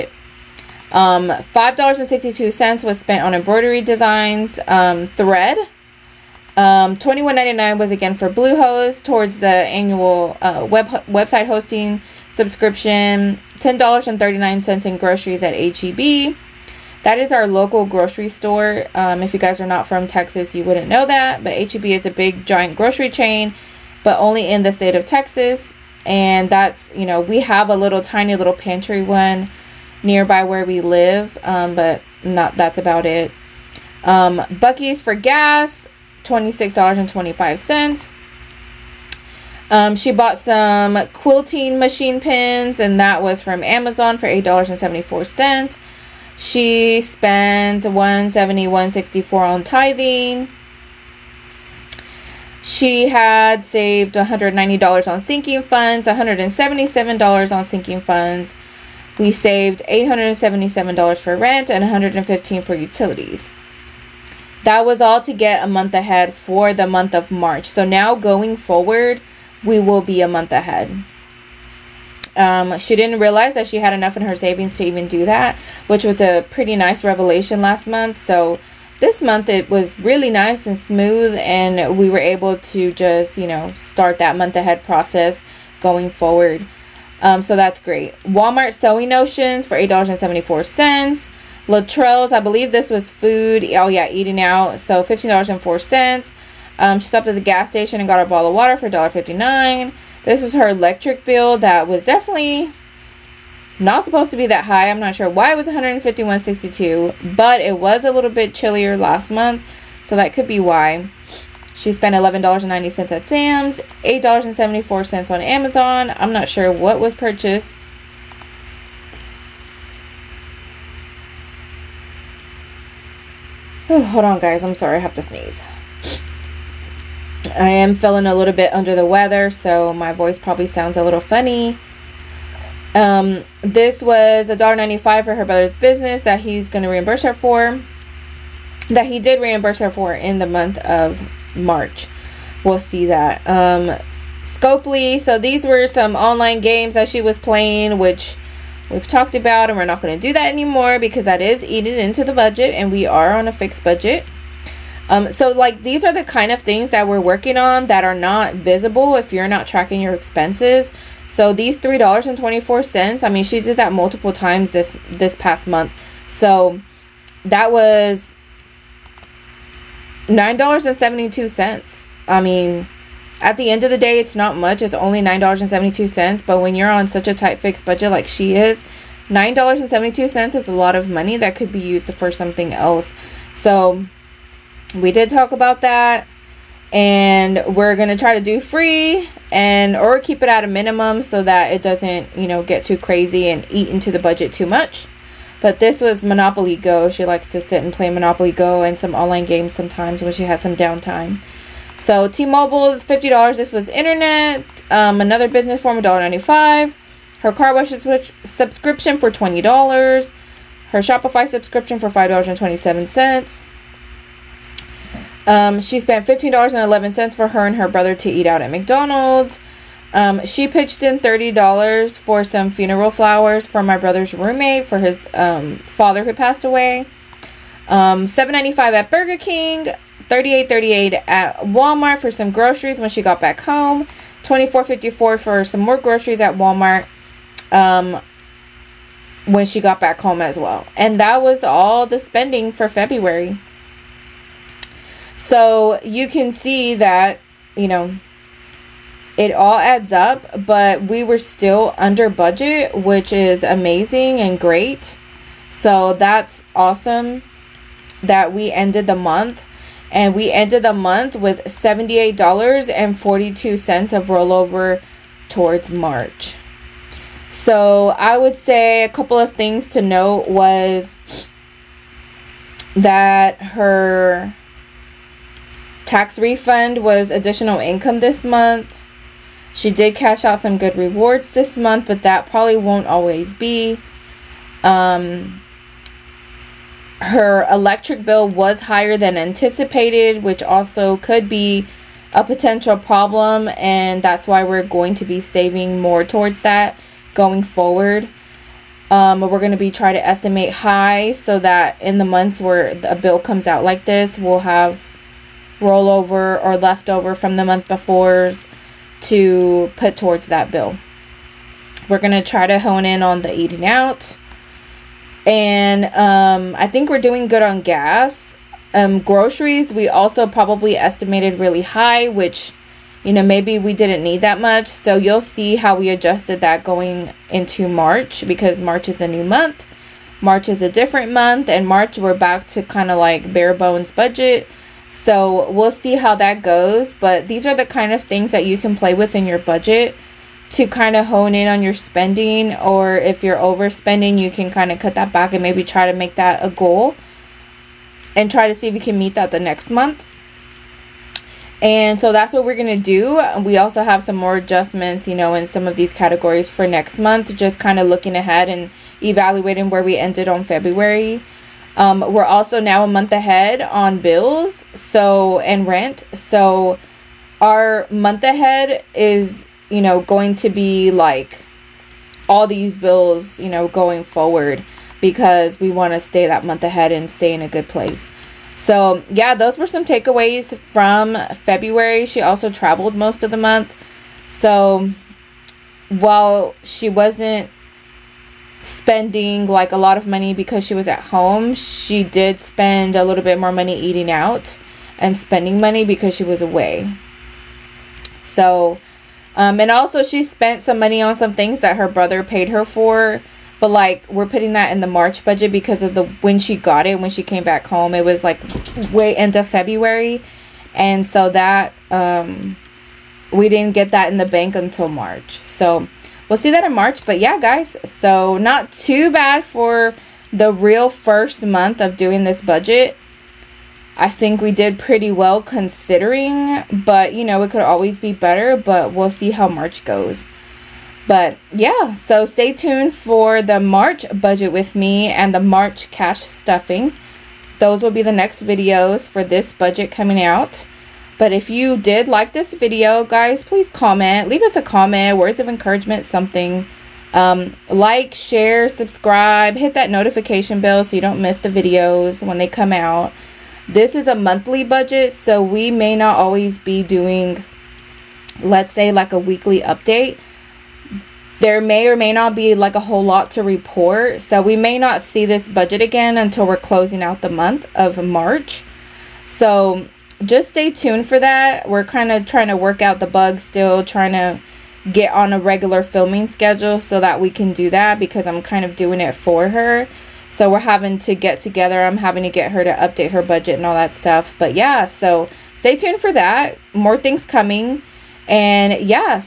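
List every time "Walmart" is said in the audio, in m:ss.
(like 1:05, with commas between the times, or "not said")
1:28, 3:51, 3:56.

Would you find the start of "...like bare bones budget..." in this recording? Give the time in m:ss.
5:33.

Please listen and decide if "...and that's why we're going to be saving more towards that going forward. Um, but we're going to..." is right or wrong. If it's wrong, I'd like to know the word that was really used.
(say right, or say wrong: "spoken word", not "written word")
right.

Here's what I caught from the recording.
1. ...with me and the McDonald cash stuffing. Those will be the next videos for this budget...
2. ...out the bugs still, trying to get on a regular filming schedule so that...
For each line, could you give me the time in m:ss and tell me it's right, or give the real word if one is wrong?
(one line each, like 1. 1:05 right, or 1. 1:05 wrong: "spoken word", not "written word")
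1. 7:14 wrong: "March", not "McDonald"
2. 7:53 right.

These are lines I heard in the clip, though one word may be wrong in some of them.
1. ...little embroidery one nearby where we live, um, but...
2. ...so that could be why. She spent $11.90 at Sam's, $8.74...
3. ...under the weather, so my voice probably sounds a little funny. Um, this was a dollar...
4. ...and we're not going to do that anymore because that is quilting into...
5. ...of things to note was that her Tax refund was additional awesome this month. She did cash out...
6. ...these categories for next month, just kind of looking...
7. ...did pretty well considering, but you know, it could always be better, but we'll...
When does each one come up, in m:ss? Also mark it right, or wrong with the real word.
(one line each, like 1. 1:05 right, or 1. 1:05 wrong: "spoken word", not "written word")
1. 0:28 wrong: "pantry", not "embroidery"
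2. 1:50 right
3. 2:08 right
4. 2:29 wrong: "eating", not "quilting"
5. 4:29 wrong: "income", not "awesome"
6. 5:55 right
7. 7:04 right.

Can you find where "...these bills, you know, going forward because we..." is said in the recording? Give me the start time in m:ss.
6:12.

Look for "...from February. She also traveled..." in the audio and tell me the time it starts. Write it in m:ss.
6:20.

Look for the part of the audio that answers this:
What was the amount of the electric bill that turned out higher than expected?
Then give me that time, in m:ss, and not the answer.
1:45.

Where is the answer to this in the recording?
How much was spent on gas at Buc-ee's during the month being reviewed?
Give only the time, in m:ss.
0:36.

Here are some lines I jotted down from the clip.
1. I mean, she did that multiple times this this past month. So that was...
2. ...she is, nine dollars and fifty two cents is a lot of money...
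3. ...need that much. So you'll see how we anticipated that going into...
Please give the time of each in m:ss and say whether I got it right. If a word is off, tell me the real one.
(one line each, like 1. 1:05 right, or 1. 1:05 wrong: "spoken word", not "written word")
1. 2:43 right
2. 2:58 wrong: "seventy", not "fifty"
3. 5:24 wrong: "adjusted", not "anticipated".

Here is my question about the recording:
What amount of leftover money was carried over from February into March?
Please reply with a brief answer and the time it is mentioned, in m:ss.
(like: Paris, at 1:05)
$78.42, at 4:21.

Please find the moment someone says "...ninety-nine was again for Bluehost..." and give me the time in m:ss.
0:07.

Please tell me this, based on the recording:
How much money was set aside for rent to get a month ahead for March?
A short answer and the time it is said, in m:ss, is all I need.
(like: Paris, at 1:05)
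$877, at 0:59.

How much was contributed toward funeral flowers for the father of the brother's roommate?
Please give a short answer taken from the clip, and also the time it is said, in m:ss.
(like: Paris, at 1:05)
$30, at 3:41.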